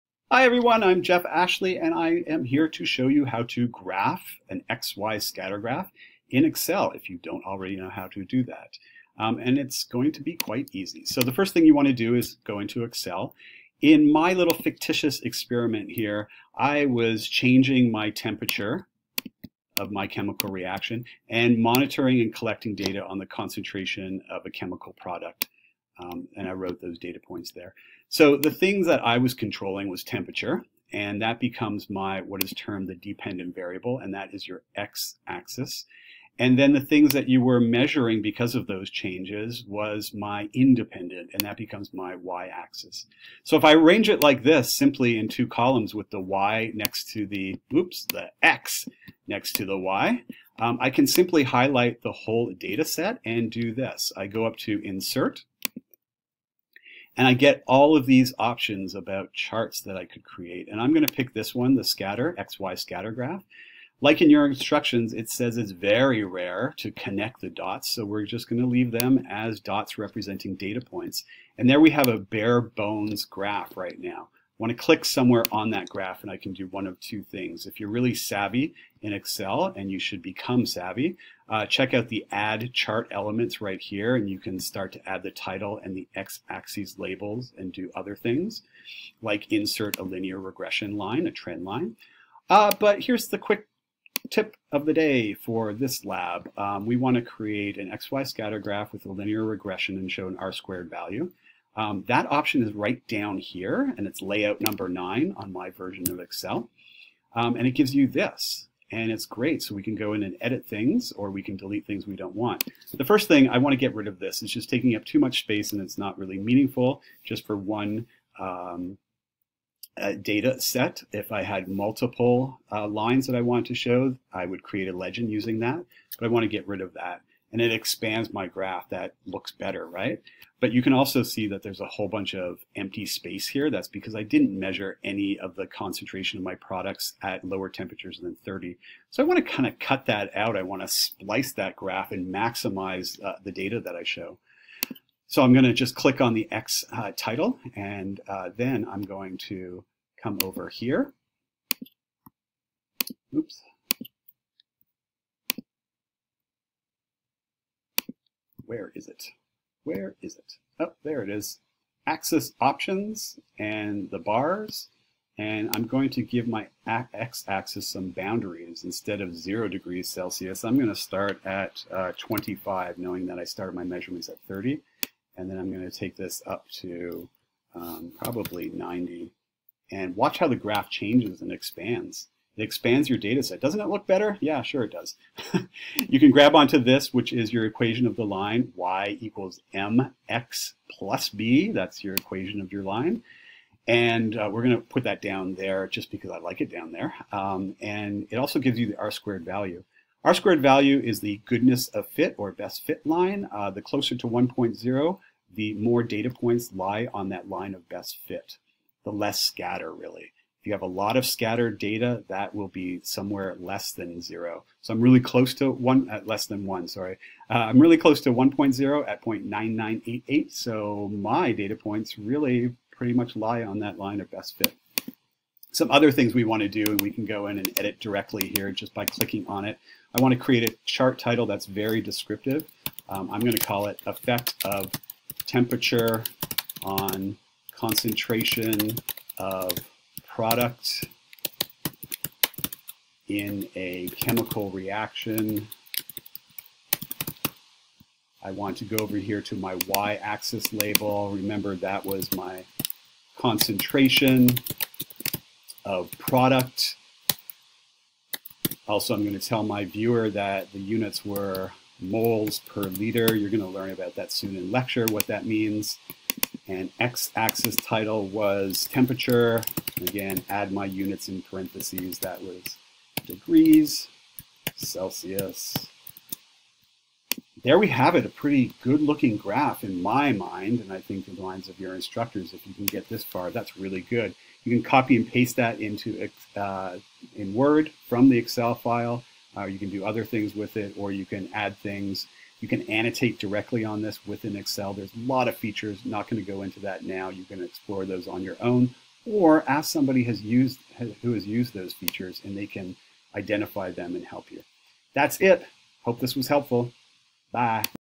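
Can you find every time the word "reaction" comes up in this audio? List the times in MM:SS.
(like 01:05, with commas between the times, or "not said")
00:20, 04:04.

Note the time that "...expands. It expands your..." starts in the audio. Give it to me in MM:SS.
03:01.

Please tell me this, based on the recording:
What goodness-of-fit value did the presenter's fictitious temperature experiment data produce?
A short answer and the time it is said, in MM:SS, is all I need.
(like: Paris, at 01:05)
0.9988, at 03:39.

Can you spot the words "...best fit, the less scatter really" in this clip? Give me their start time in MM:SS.
03:27.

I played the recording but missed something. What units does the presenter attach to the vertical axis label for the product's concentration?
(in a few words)
moles per liter.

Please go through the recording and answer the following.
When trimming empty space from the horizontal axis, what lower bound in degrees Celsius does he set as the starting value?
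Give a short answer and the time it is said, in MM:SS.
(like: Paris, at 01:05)
25, at 02:52.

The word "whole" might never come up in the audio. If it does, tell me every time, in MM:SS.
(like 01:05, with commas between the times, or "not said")
00:52, 02:11.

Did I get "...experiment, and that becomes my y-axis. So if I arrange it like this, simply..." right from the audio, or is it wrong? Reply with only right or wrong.
wrong.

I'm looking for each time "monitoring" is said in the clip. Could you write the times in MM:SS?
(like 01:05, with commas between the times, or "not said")
00:21.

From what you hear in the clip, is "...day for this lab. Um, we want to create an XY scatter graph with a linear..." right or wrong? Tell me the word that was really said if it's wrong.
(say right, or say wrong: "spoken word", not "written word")
right.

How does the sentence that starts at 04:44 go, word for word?
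You can copy and paste that into uh, in Word from the Excel file.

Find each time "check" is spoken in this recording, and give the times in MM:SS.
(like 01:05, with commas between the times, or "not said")
01:21.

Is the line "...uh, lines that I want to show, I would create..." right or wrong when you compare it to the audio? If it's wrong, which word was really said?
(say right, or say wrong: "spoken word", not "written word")
right.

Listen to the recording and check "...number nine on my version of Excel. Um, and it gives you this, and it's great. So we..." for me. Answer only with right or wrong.
right.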